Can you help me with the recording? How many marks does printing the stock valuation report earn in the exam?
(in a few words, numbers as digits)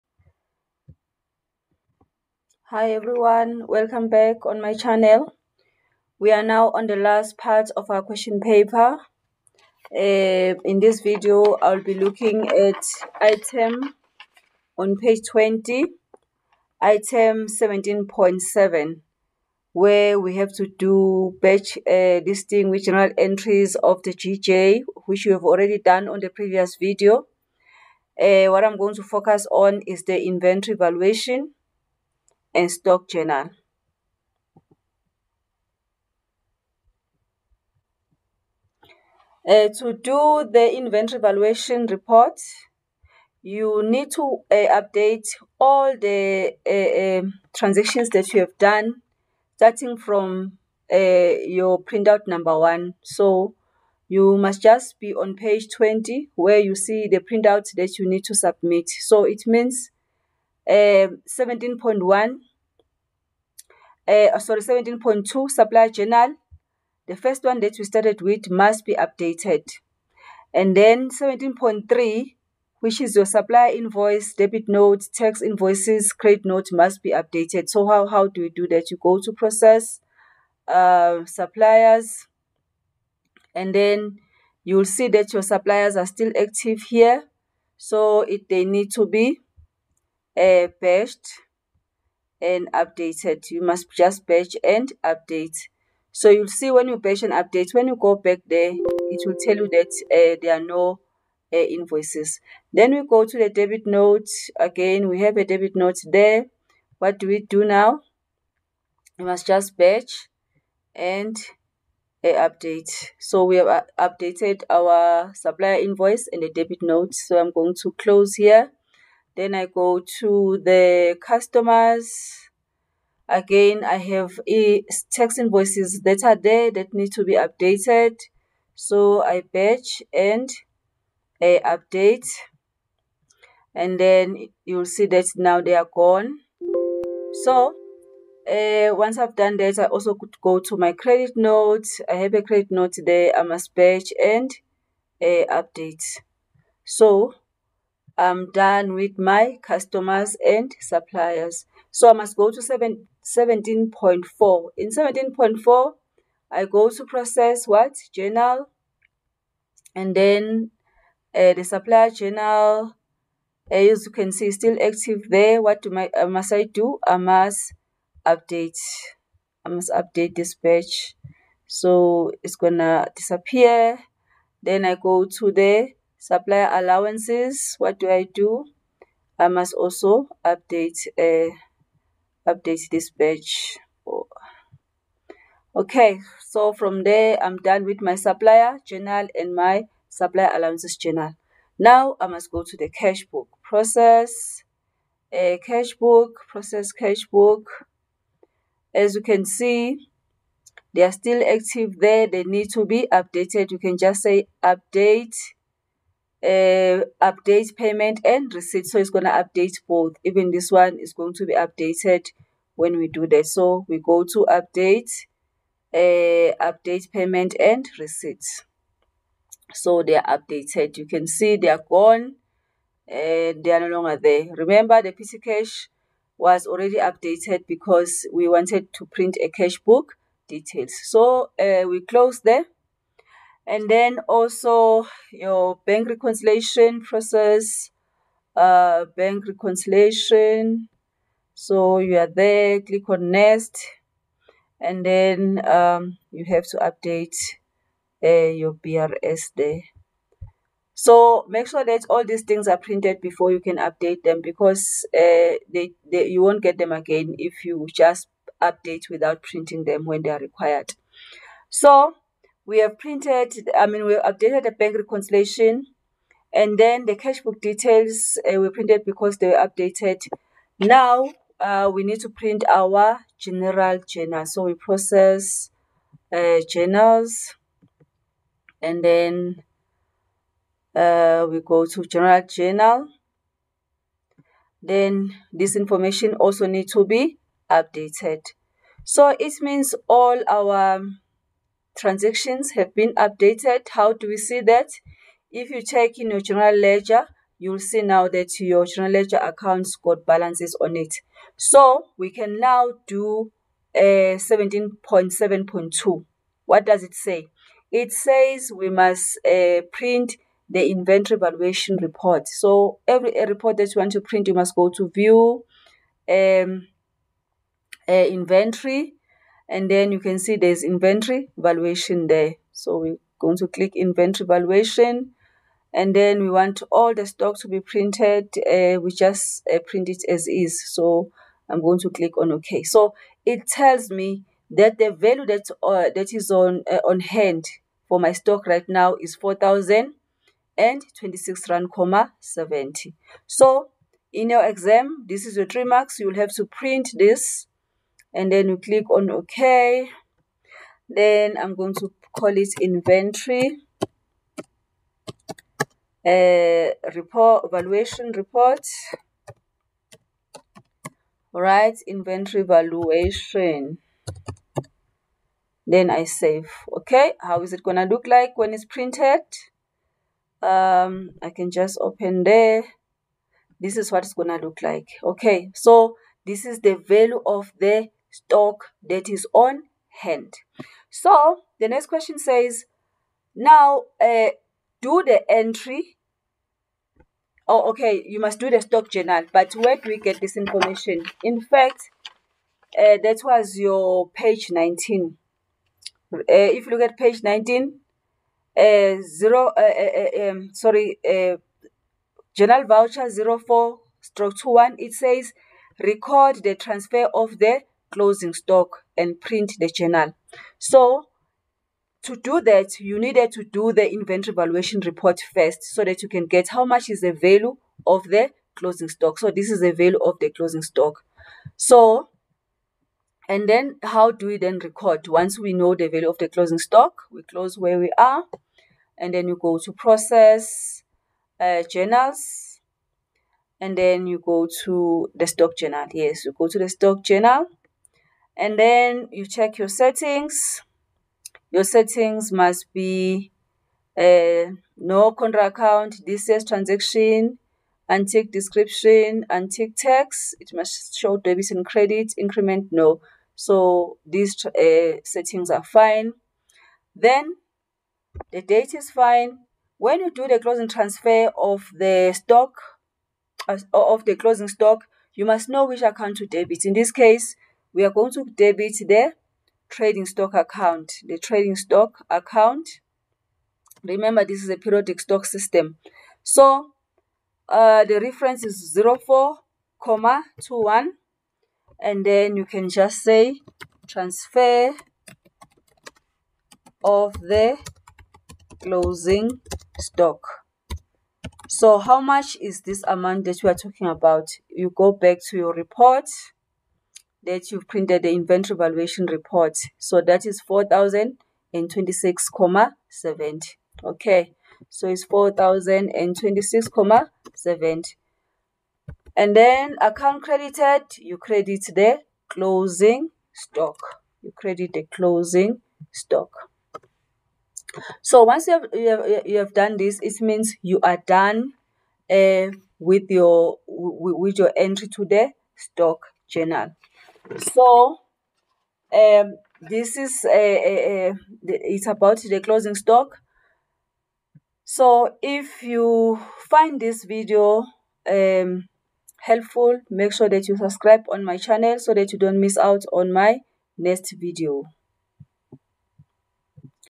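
3.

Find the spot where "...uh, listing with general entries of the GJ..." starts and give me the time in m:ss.
0:21.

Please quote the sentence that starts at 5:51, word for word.
Then I'm going to call it inventory uh, report Evaluation report.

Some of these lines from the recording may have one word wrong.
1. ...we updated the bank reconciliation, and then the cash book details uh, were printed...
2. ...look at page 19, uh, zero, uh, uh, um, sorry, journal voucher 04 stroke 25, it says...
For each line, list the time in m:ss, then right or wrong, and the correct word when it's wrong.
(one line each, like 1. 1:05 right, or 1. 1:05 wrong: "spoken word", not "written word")
1. 4:24 right
2. 6:36 wrong: "21", not "25".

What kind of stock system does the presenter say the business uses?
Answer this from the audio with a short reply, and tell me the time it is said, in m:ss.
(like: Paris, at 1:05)
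Periodic, at 7:54.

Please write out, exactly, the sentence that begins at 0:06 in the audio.
We are now on the last part of our question paper.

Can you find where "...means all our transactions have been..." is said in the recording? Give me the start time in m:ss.
4:49.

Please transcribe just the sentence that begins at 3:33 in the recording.
So we go to update, uh, update payment and receipt.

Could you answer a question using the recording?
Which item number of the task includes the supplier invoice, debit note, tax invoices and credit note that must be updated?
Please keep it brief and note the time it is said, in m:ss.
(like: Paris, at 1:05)
17.3, at 1:11.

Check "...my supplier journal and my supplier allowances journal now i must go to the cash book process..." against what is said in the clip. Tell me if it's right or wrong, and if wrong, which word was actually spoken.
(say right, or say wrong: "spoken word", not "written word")
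right.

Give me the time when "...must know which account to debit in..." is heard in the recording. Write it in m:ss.
7:45.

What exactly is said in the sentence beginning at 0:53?
So you must just be on page 20 where you see the printout that you need to submit.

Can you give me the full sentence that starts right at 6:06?
Okay, how is it gonna look like when it's printed?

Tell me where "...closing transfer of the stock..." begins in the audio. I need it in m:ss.
7:40.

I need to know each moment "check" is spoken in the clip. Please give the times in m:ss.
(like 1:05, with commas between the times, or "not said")
4:55, 7:19.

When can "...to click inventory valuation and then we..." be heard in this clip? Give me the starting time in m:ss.
5:23.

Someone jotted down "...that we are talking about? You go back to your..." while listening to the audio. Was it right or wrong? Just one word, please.
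right.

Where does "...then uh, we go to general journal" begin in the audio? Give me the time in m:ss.
4:39.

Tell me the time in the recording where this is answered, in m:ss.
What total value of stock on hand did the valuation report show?
5:39.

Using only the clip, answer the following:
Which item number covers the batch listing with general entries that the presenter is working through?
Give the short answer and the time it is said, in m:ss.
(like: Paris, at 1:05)
17.7, at 0:16.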